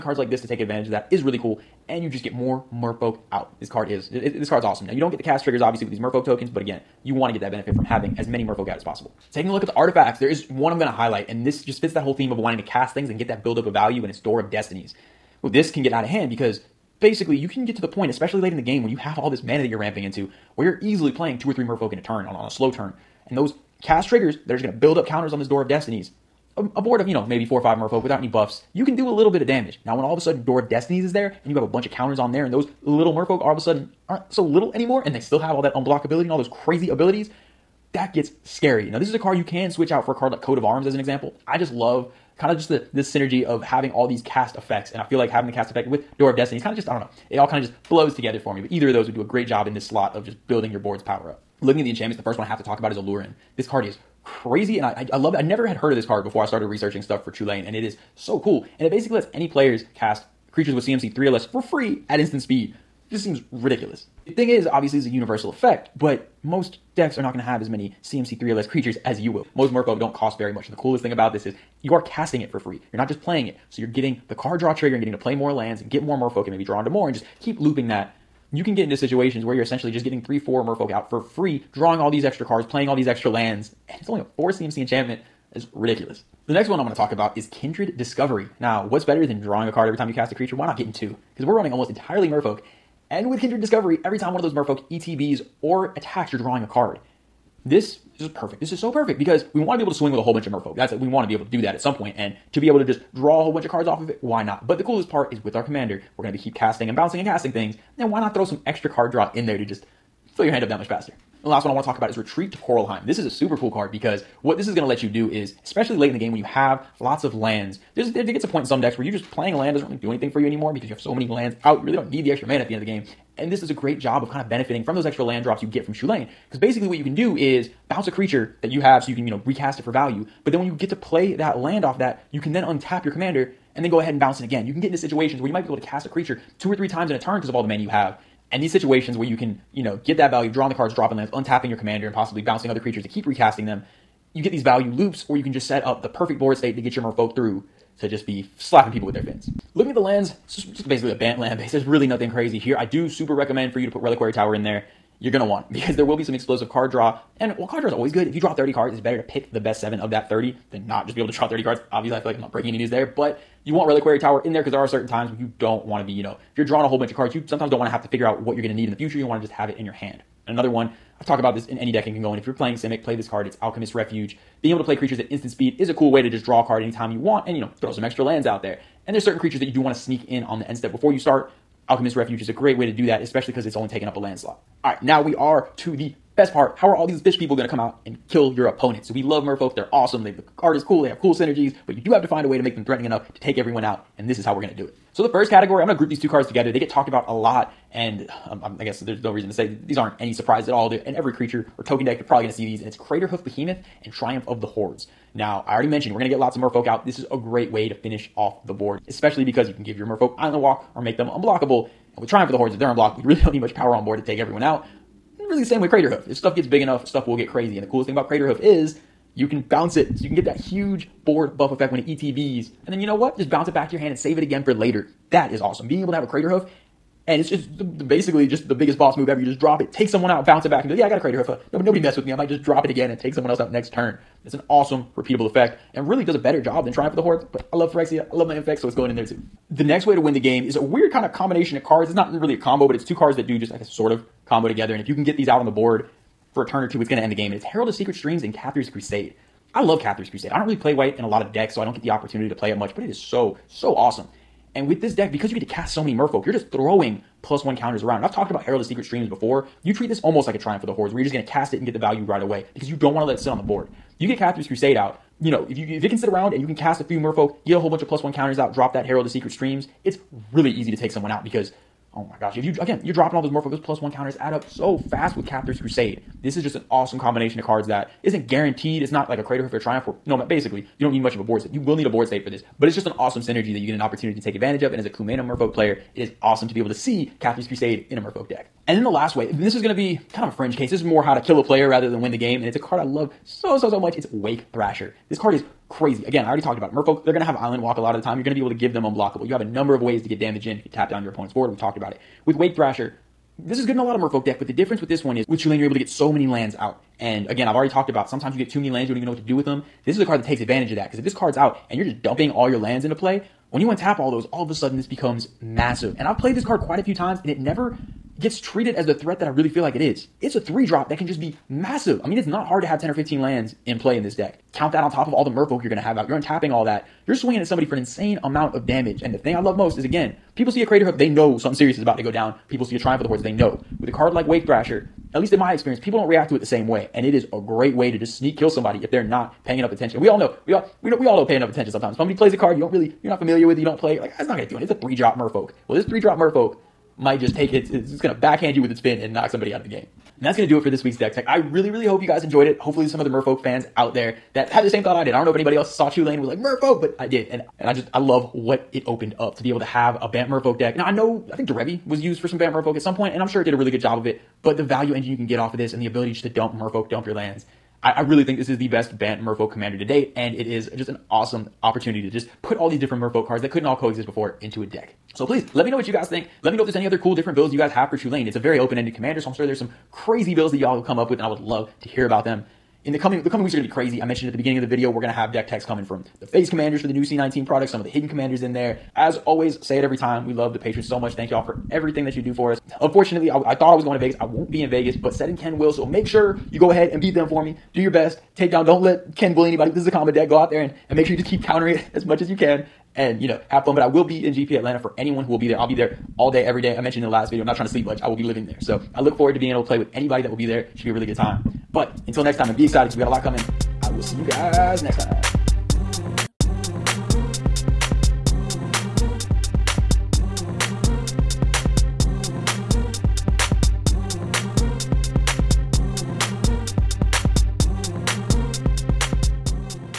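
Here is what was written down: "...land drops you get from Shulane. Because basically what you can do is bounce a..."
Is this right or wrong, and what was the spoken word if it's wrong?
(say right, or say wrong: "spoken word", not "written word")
right.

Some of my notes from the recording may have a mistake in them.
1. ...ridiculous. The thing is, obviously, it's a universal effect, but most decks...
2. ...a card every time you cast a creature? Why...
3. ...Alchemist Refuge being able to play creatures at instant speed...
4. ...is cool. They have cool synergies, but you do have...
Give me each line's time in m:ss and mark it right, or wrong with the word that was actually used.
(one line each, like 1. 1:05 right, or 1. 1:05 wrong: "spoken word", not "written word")
1. 1:03 right
2. 1:29 right
3. 2:53 right
4. 3:10 right.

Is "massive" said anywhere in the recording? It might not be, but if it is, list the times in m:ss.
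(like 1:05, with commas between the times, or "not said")
5:15, 5:21.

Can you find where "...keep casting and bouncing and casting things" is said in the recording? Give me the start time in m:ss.
1:46.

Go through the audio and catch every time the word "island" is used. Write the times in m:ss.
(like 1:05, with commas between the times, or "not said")
3:30, 4:57.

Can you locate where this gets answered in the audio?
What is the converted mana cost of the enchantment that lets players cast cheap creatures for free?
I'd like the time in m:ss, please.
1:24.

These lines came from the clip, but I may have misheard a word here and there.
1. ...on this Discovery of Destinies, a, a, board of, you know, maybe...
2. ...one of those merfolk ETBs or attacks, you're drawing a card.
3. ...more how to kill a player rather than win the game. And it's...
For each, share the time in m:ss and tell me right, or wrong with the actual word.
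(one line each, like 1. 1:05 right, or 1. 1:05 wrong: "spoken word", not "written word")
1. 0:25 wrong: "Door", not "Discovery"
2. 1:34 right
3. 4:51 right.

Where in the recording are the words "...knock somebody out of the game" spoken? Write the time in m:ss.
5:49.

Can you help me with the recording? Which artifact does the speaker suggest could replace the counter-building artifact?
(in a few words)
Coat of Arms.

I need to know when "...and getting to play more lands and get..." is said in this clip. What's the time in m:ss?
1:14.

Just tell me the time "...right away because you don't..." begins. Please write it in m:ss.
4:22.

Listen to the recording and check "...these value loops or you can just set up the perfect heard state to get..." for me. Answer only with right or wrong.
wrong.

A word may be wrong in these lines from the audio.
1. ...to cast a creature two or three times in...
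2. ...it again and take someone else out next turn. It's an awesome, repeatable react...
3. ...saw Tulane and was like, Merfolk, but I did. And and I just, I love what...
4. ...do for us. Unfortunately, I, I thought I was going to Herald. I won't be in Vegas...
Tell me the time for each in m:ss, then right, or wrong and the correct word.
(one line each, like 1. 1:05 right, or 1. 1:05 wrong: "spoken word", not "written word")
1. 2:15 right
2. 3:52 wrong: "effect", not "react"
3. 5:55 right
4. 6:32 wrong: "Vegas", not "Herald".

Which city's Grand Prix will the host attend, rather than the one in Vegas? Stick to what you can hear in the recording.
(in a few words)
Atlanta.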